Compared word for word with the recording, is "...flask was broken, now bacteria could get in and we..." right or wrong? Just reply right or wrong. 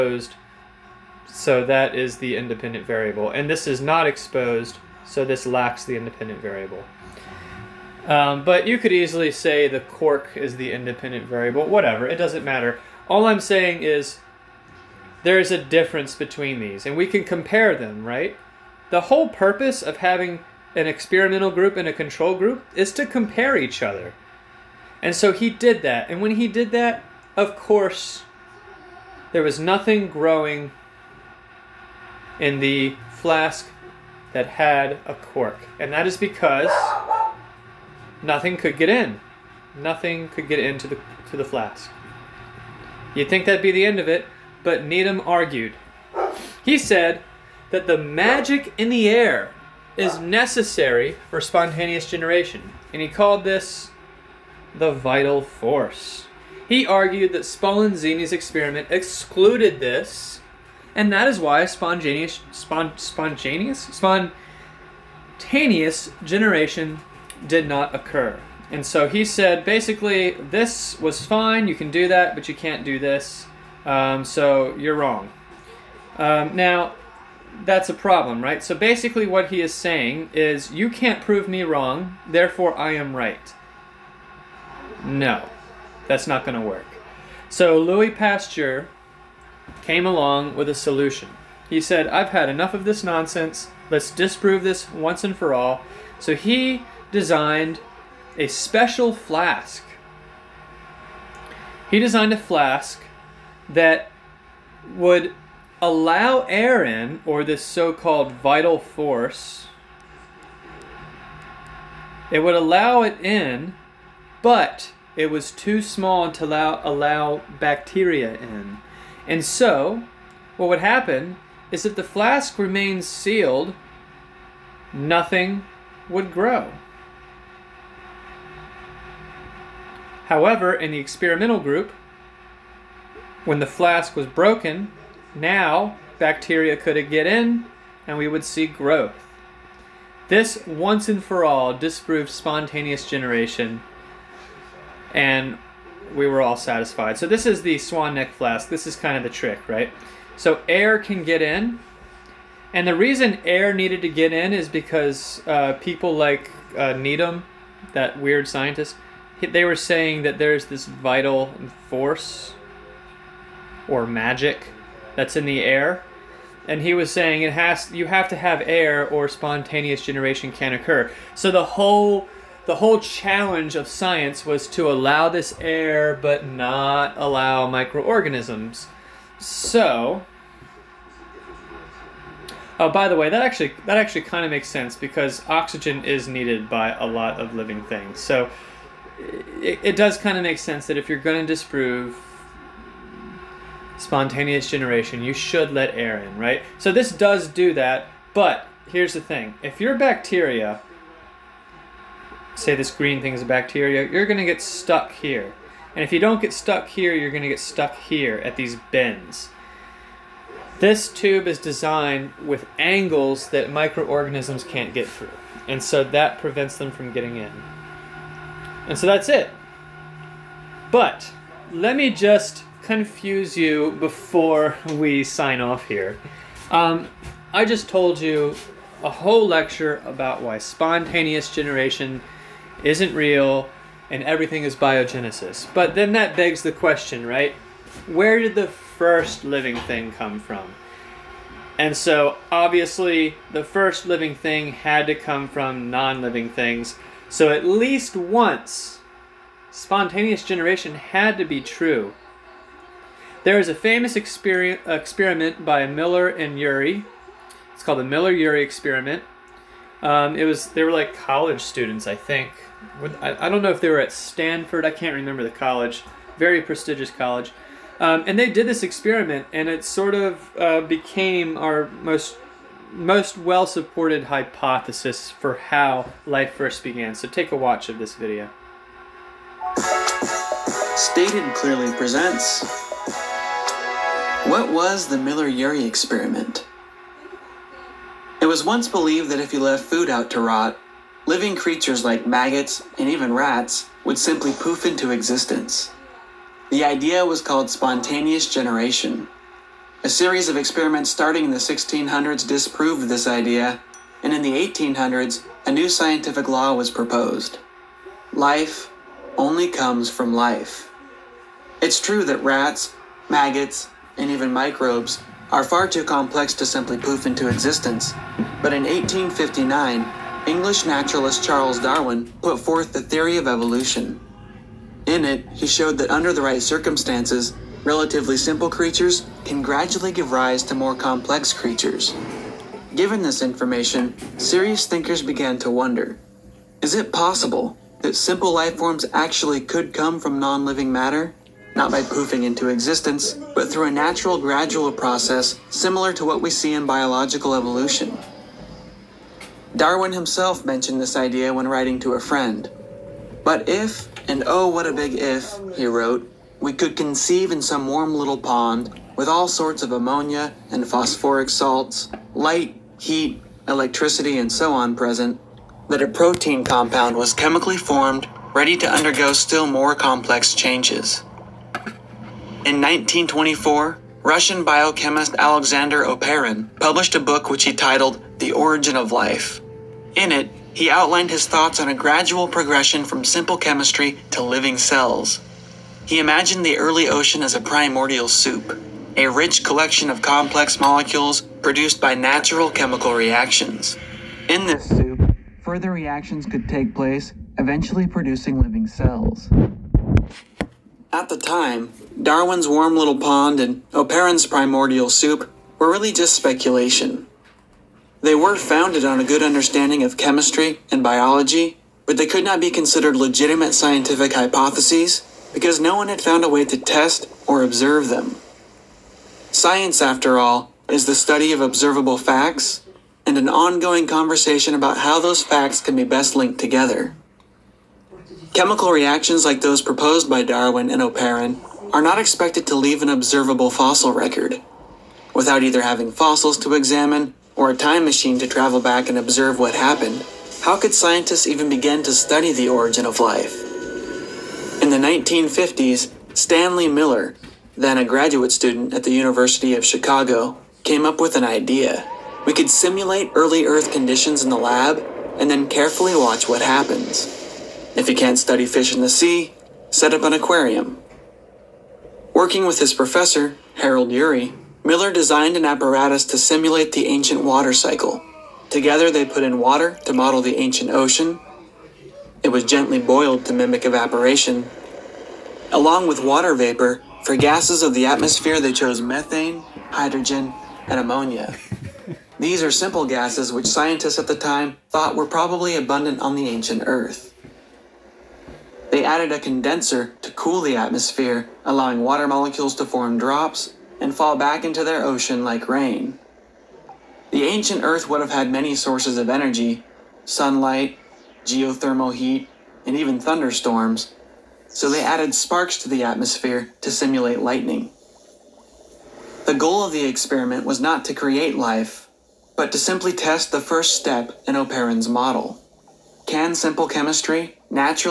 right.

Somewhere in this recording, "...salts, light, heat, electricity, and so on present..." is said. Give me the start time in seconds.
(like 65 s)
361 s.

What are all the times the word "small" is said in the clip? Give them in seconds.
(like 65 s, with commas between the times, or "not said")
115 s.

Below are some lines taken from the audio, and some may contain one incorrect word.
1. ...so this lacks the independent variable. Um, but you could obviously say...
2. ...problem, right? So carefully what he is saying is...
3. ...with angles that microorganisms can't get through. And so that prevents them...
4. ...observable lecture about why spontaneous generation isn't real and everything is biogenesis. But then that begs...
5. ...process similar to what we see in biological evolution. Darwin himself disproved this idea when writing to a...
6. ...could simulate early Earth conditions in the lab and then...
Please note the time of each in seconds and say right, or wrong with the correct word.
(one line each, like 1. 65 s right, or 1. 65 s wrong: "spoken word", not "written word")
1. 5 s wrong: "easily", not "obviously"
2. 77 s wrong: "basically", not "carefully"
3. 212 s right
4. 229 s wrong: "whole", not "observable"
5. 344 s wrong: "mentioned", not "disproved"
6. 452 s right.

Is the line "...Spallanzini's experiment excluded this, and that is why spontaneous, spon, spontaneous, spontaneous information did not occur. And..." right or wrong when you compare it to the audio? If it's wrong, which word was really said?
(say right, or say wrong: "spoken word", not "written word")
wrong: "generation", not "information".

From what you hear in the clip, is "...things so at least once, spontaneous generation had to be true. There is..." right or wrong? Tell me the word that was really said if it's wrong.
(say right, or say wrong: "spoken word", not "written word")
right.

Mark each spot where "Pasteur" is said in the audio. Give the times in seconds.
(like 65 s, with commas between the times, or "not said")
88 s.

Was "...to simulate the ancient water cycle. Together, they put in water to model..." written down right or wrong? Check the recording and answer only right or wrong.
right.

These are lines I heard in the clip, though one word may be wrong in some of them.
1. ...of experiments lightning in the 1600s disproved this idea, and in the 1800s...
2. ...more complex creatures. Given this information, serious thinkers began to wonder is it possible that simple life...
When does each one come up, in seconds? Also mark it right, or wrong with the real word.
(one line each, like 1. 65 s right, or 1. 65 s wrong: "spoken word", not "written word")
1. 300 s wrong: "starting", not "lightning"
2. 330 s right.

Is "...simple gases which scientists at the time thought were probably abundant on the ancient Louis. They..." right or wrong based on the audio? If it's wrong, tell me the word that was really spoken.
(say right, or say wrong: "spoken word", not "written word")
wrong: "Earth", not "Louis".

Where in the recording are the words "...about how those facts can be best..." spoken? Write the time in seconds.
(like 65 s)
424 s.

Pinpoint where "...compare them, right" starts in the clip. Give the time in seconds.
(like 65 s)
17 s.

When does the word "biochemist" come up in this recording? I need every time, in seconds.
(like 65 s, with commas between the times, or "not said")
374 s.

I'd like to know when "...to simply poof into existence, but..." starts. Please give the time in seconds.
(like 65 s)
316 s.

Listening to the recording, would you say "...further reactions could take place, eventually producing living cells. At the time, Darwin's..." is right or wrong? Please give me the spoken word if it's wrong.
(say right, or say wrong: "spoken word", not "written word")
right.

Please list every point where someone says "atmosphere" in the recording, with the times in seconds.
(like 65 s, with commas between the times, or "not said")
478 s, 490 s, 506 s.